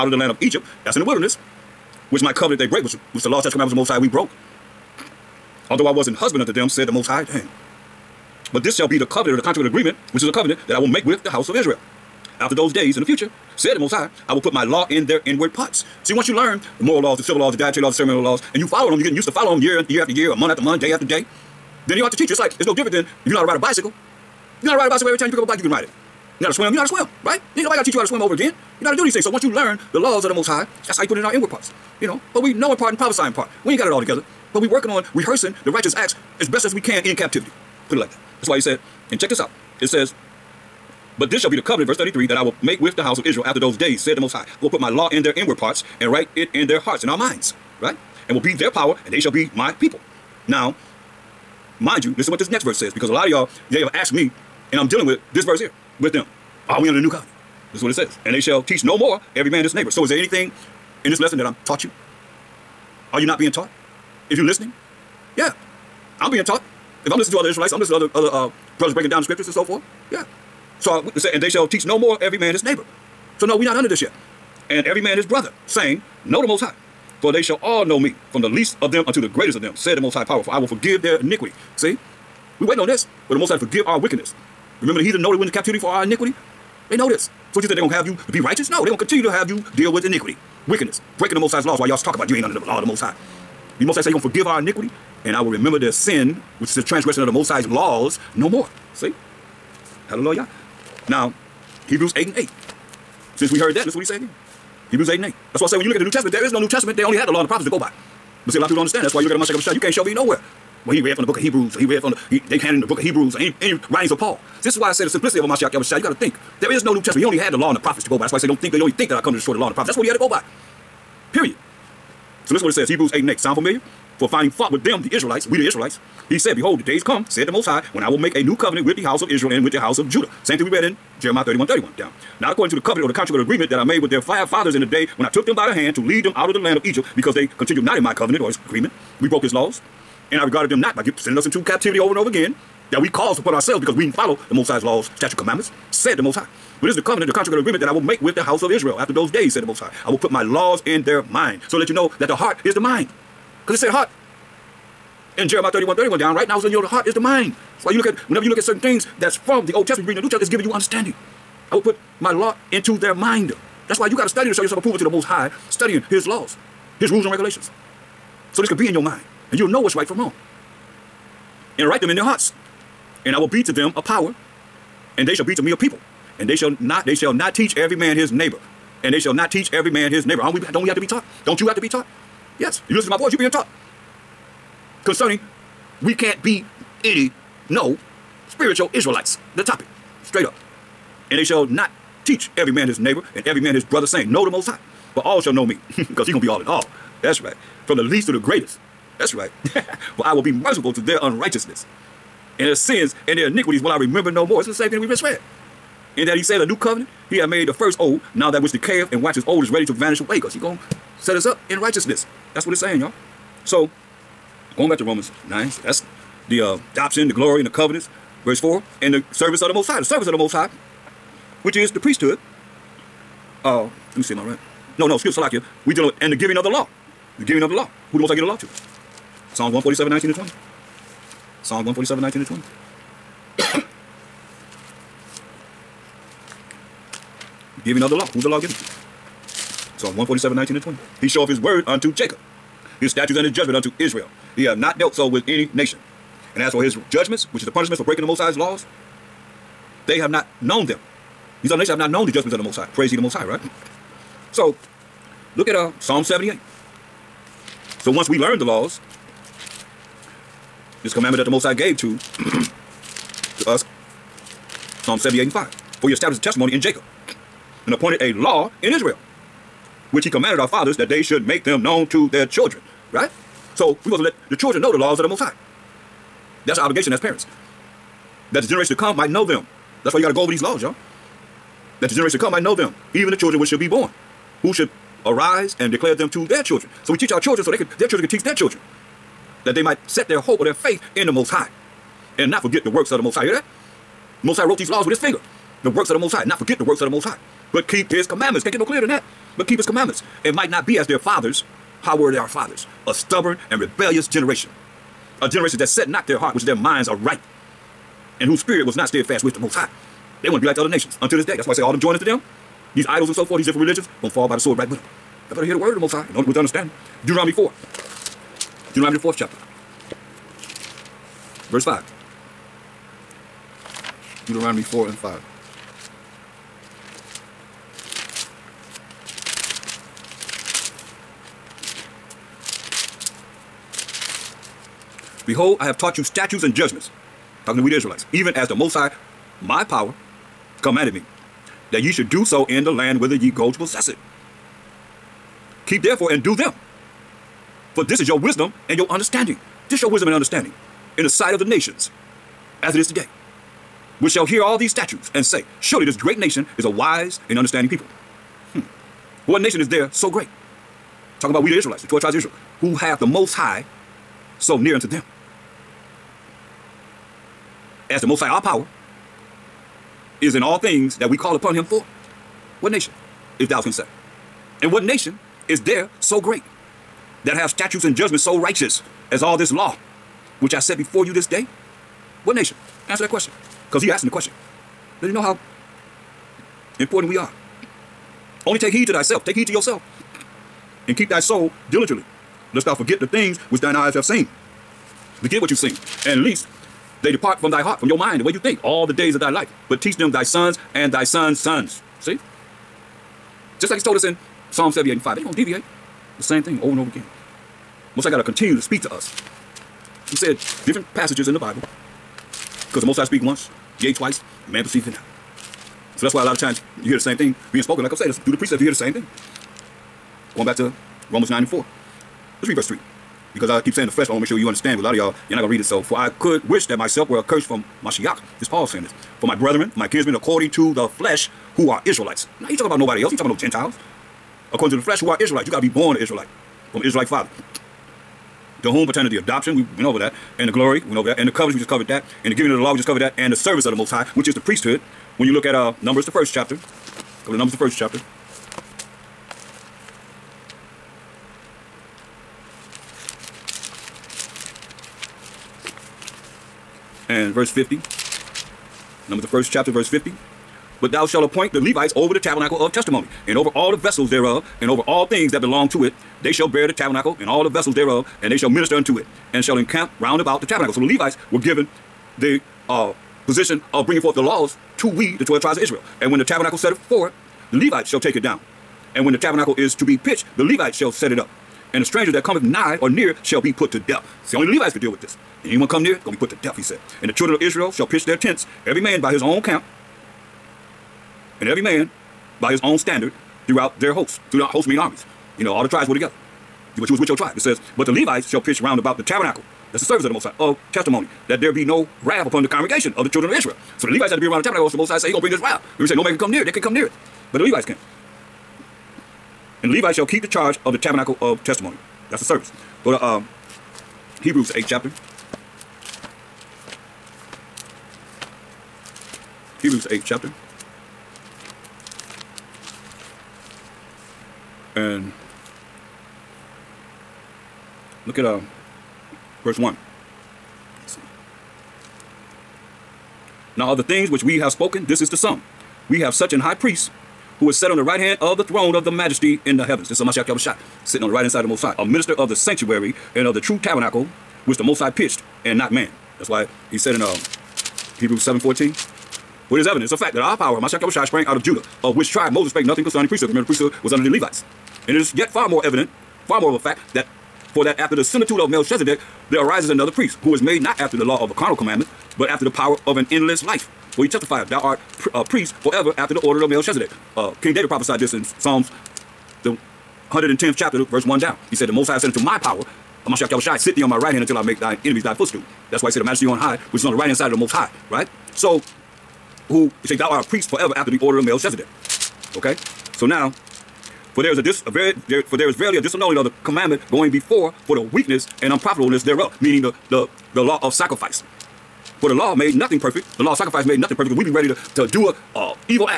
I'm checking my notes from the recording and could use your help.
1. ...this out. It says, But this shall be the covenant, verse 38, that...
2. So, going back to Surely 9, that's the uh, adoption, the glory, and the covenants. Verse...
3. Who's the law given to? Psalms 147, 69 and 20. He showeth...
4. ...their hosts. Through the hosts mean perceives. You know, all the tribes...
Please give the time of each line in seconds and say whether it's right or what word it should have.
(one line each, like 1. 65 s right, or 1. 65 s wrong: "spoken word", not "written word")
1. 39 s wrong: "33", not "38"
2. 213 s wrong: "Romans", not "Surely"
3. 238 s wrong: "19", not "69"
4. 493 s wrong: "armies", not "perceives".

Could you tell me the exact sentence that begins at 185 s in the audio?
Concerning, we can't be any, no, spiritual Israelites.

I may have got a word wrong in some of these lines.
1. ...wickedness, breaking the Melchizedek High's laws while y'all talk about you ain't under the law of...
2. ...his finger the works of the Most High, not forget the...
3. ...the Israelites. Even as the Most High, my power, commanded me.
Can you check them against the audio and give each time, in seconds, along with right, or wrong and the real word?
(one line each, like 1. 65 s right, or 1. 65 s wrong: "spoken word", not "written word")
1. 90 s wrong: "Most", not "Melchizedek"
2. 295 s right
3. 337 s right.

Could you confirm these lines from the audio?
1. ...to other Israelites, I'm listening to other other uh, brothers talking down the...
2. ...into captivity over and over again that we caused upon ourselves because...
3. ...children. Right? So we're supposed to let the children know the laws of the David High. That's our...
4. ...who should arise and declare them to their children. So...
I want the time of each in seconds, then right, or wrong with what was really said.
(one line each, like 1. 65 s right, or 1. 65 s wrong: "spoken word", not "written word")
1. 67 s wrong: "breaking", not "talking"
2. 141 s right
3. 272 s wrong: "Most", not "David"
4. 284 s right.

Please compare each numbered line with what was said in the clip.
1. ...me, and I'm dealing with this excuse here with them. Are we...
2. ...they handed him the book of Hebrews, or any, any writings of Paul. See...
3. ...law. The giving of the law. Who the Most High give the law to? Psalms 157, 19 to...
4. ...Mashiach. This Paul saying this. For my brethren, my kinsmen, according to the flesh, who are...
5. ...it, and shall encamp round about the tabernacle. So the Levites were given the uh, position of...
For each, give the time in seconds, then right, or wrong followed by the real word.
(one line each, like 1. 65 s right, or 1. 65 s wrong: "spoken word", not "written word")
1. 54 s wrong: "verse", not "excuse"
2. 112 s right
3. 226 s wrong: "147", not "157"
4. 428 s right
5. 469 s right.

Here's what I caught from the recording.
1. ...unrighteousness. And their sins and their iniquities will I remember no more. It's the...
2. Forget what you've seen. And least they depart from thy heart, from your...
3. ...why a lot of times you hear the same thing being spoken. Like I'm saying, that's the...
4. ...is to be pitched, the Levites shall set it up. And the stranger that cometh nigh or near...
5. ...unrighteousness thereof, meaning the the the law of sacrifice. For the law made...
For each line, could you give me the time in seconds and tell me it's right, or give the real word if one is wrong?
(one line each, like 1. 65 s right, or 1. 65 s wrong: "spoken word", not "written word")
1. 201 s right
2. 395 s right
3. 416 s right
4. 479 s right
5. 588 s wrong: "unprofitableness", not "unrighteousness".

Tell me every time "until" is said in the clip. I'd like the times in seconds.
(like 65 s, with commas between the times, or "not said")
311 s, 574 s.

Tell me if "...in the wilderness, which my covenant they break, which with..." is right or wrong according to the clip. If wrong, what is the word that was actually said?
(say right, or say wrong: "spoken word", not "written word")
right.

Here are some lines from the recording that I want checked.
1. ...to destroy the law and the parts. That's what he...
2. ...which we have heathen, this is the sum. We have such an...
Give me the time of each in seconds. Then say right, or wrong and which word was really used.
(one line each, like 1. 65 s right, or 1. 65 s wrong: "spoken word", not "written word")
1. 119 s wrong: "prophets", not "parts"
2. 534 s wrong: "spoken", not "heathen".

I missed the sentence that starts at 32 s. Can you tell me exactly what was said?
But we know in part and prophesy in part.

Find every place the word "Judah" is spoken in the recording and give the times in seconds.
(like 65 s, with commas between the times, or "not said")
130 s, 551 s.